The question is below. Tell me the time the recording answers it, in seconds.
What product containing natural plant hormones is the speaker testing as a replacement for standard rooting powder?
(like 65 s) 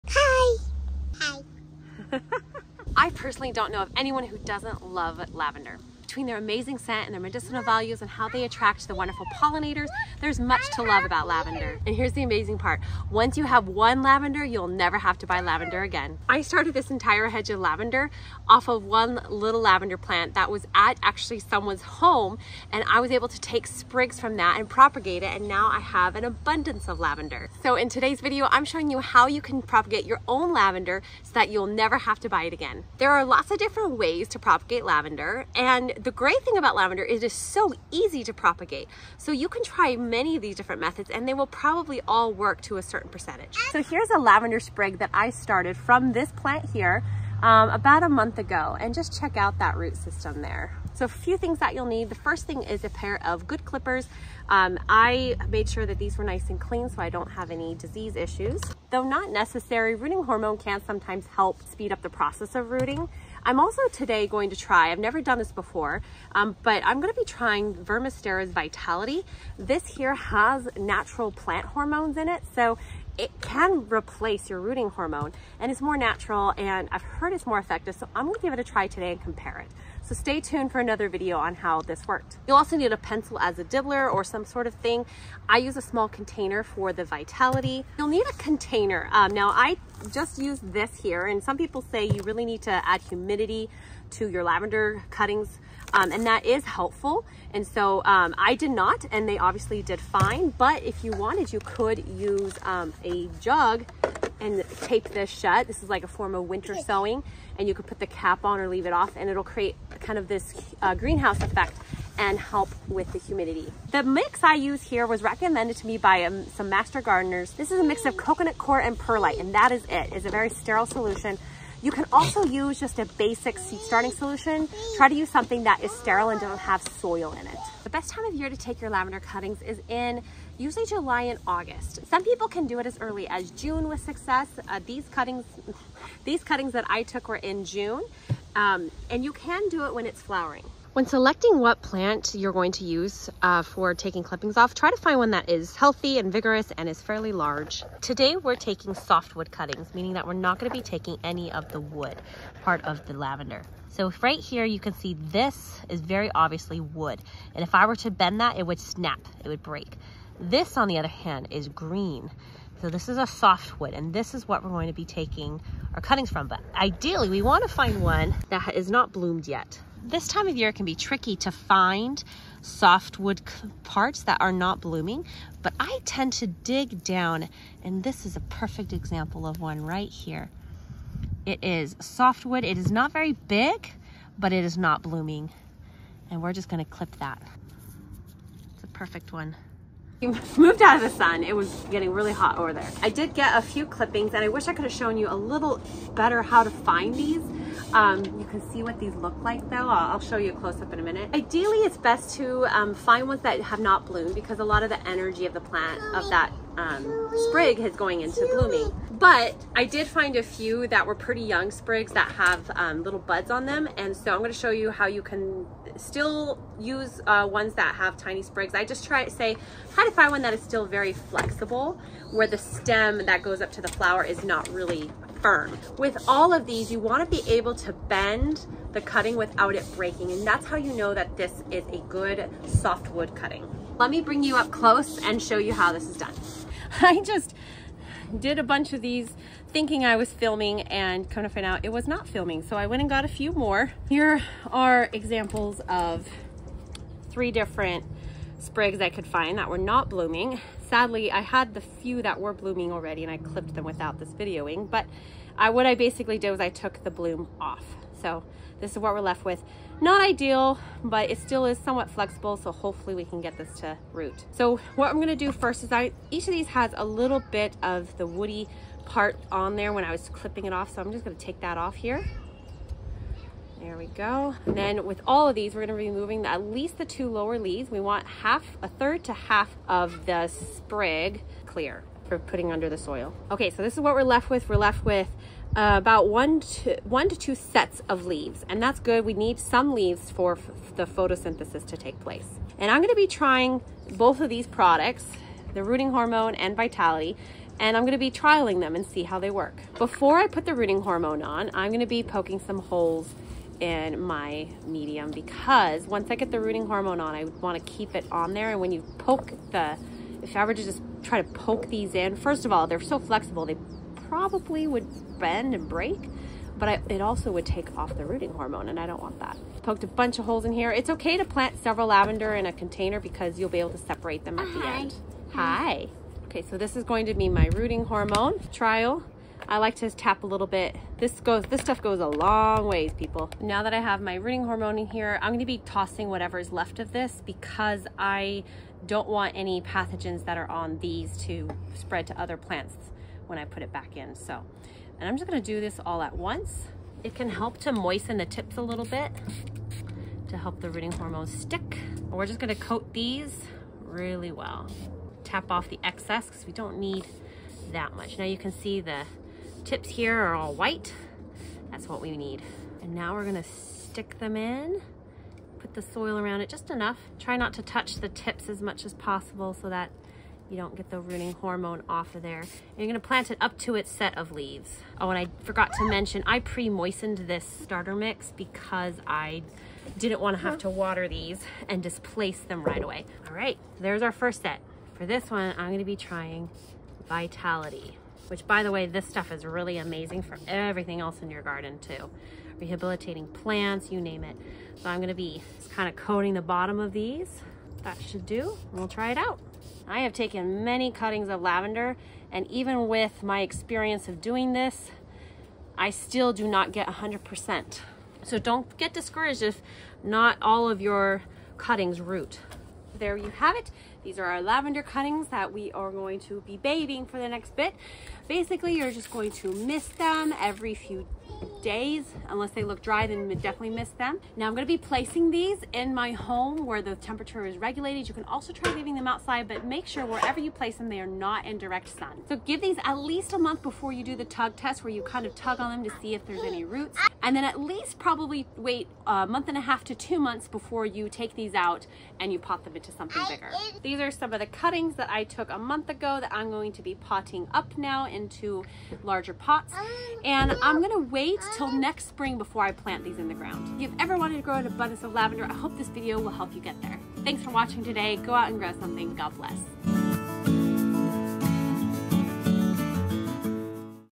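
67 s.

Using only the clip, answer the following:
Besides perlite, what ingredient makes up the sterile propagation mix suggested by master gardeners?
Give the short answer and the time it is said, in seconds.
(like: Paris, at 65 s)
coconut coir, at 118 s.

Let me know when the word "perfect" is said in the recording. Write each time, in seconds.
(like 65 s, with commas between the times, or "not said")
178 s, 188 s.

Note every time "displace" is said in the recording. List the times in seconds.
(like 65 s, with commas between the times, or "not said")
382 s.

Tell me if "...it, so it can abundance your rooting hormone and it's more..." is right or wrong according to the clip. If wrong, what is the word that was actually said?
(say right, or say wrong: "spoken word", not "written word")
wrong: "replace", not "abundance".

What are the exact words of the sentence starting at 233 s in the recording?
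Let me bring you up close and show you how this is done.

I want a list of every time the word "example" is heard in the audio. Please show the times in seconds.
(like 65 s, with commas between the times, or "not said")
178 s, 245 s.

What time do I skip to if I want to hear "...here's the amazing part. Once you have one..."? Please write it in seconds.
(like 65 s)
11 s.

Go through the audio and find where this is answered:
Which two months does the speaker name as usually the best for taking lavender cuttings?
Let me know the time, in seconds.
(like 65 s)
130 s.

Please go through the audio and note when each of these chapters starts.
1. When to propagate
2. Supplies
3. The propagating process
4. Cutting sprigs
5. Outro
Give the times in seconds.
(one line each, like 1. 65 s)
1. 127 s
2. 50 s
3. 201 s
4. 140 s
5. 413 s.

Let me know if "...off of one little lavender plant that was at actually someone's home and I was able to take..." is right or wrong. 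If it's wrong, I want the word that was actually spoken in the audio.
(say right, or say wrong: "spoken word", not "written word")
right.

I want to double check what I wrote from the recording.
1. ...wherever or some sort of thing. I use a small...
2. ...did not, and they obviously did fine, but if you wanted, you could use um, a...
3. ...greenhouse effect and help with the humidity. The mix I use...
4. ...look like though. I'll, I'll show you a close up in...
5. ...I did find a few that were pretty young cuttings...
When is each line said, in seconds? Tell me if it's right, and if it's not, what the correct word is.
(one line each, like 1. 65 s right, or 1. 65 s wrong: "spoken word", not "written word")
1. 83 s wrong: "dibbler", not "wherever"
2. 98 s right
3. 110 s right
4. 199 s right
5. 209 s wrong: "sprigs", not "cuttings".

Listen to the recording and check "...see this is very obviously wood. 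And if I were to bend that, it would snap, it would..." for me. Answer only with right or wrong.
right.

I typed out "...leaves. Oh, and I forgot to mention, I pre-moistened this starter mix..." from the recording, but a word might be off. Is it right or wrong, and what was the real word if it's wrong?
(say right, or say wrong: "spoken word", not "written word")
right.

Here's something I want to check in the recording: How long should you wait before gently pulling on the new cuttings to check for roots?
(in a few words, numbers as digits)
at least a month.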